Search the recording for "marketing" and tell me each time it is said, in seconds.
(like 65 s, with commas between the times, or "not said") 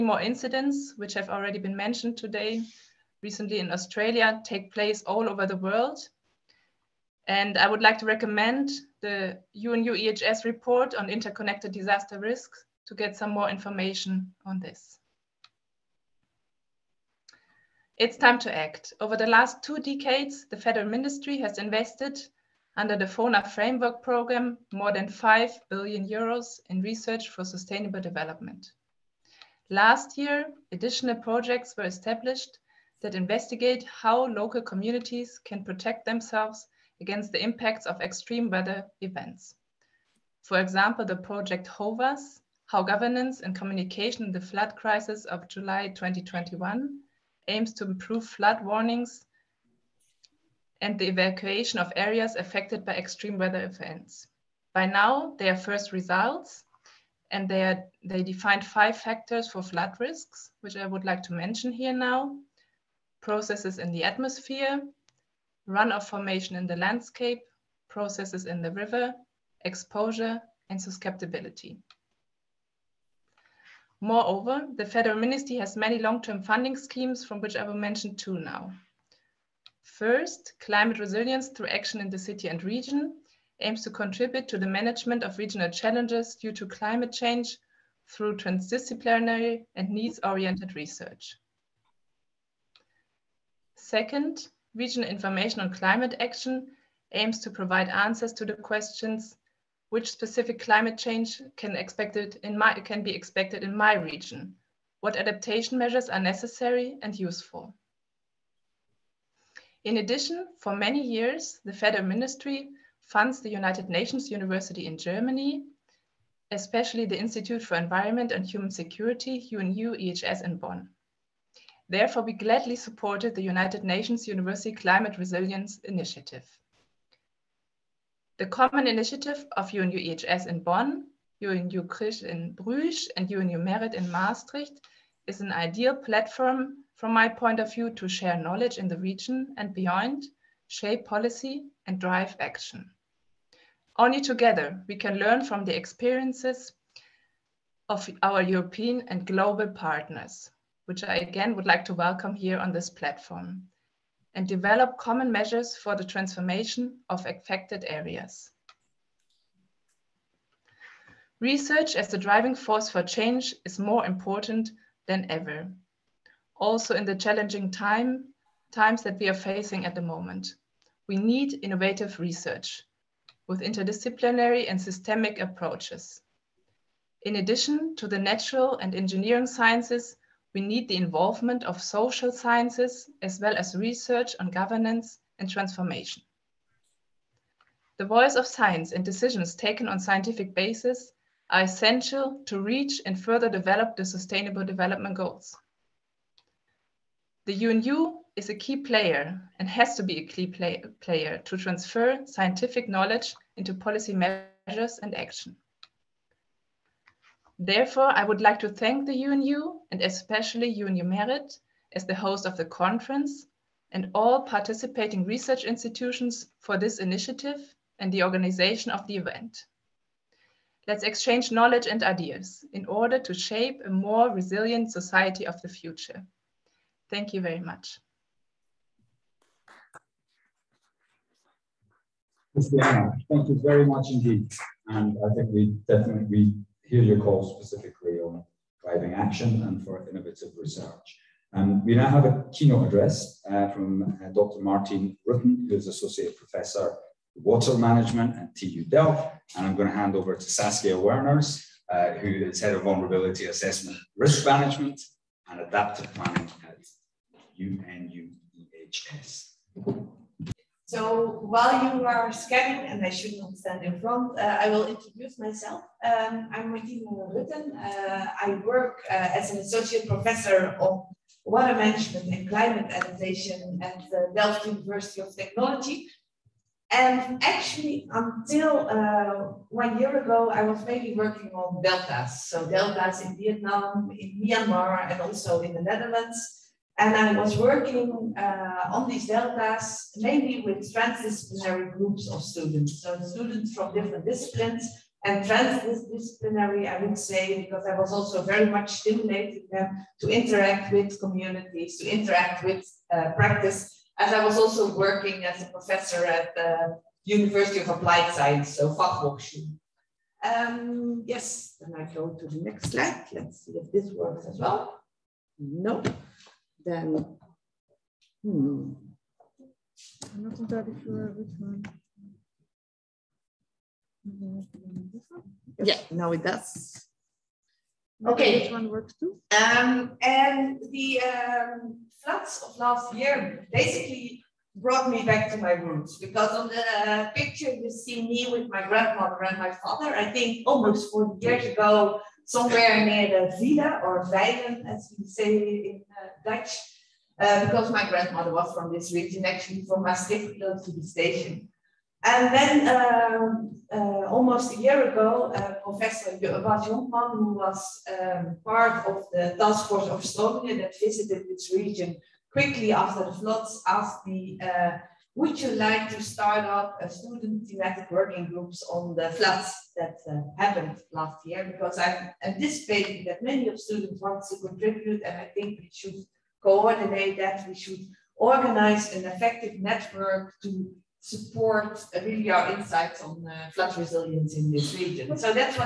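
not said.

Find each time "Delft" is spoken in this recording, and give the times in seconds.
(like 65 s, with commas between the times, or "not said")
248 s, 274 s.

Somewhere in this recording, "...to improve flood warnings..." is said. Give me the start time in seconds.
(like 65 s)
47 s.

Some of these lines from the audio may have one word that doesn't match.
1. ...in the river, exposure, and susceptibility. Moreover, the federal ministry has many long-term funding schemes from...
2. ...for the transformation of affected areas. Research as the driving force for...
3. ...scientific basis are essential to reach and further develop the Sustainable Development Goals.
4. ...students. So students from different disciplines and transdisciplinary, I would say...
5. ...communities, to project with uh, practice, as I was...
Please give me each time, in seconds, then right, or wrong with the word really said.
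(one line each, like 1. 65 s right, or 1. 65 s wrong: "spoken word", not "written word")
1. 68 s right
2. 155 s right
3. 189 s right
4. 292 s right
5. 301 s wrong: "interact", not "project".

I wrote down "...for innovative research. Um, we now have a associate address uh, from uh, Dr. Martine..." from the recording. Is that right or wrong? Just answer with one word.
wrong.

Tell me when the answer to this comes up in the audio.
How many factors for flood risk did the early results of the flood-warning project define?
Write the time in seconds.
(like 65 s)
58 s.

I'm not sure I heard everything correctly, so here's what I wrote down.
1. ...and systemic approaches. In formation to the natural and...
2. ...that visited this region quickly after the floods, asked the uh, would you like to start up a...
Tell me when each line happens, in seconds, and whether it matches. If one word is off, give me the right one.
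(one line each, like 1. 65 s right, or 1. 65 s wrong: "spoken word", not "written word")
1. 174 s wrong: "addition", not "formation"
2. 360 s right.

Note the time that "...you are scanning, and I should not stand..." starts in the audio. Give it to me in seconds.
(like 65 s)
261 s.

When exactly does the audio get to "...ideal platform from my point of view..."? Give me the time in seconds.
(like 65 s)
135 s.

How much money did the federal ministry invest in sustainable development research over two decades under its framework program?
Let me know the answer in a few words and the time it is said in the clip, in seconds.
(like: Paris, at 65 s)
more than 5 billion euros, at 24 s.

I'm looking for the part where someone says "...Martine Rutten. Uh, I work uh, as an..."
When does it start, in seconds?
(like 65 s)
266 s.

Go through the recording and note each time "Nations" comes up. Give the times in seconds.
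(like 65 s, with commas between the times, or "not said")
113 s, 123 s.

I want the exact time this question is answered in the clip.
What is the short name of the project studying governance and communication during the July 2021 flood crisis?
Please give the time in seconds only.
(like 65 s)
41 s.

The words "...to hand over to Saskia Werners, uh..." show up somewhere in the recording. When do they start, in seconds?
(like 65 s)
249 s.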